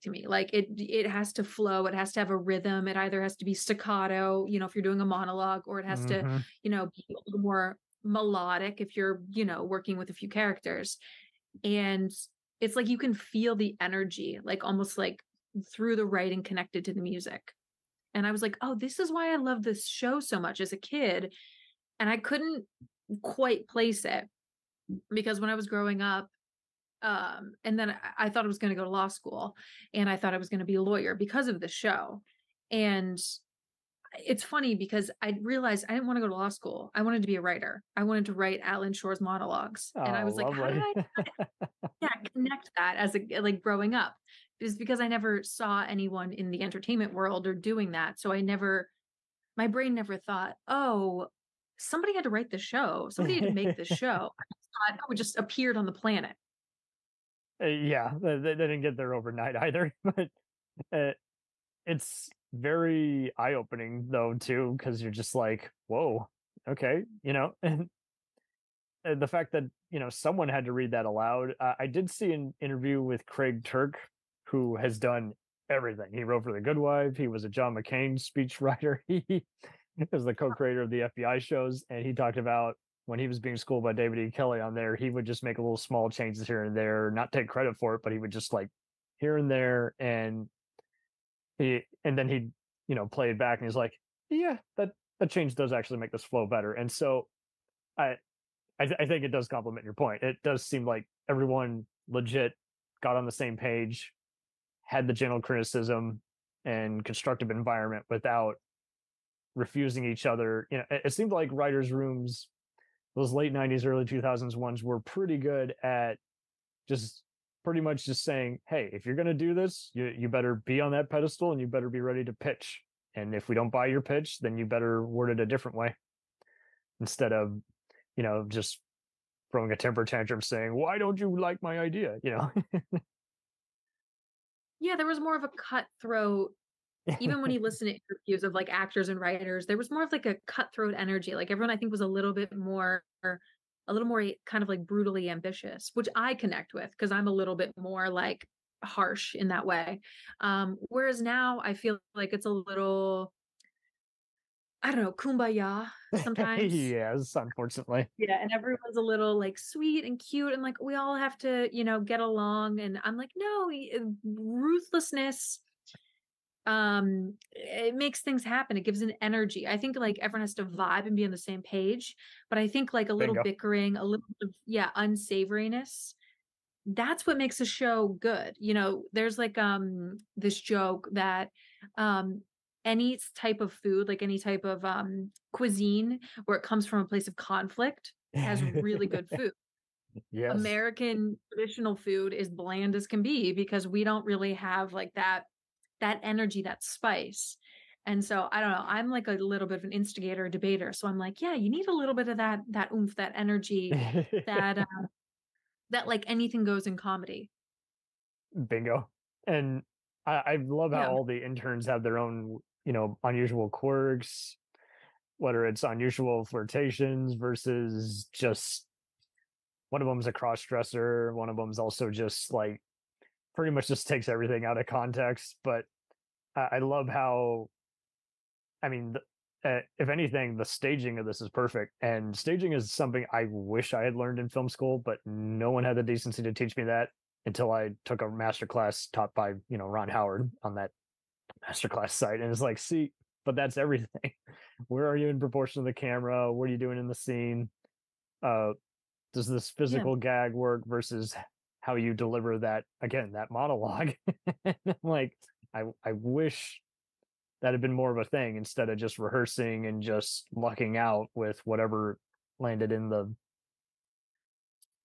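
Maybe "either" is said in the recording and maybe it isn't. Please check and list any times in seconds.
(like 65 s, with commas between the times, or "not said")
2 s, 59 s.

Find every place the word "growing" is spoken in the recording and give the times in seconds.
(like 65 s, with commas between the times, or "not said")
25 s, 43 s.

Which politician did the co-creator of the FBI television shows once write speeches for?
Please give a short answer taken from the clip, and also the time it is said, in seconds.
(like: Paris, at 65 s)
John McCain, at 77 s.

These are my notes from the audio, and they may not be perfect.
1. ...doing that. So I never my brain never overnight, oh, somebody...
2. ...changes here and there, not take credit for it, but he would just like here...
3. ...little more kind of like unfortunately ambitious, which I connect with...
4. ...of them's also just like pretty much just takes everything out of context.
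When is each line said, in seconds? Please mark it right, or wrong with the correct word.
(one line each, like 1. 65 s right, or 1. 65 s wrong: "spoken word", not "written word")
1. 47 s wrong: "thought", not "overnight"
2. 86 s right
3. 143 s wrong: "brutally", not "unfortunately"
4. 221 s right.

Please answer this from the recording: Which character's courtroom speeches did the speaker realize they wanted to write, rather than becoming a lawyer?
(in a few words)
Alan Shore.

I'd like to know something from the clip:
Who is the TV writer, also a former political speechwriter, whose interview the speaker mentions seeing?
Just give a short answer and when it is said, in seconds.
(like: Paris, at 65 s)
Craig Turk, at 73 s.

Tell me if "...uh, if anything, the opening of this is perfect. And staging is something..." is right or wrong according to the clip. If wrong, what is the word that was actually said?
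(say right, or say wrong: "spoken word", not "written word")
wrong: "staging", not "opening".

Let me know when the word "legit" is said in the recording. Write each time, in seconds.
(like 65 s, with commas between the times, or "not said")
102 s.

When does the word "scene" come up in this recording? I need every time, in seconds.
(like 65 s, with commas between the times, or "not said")
247 s.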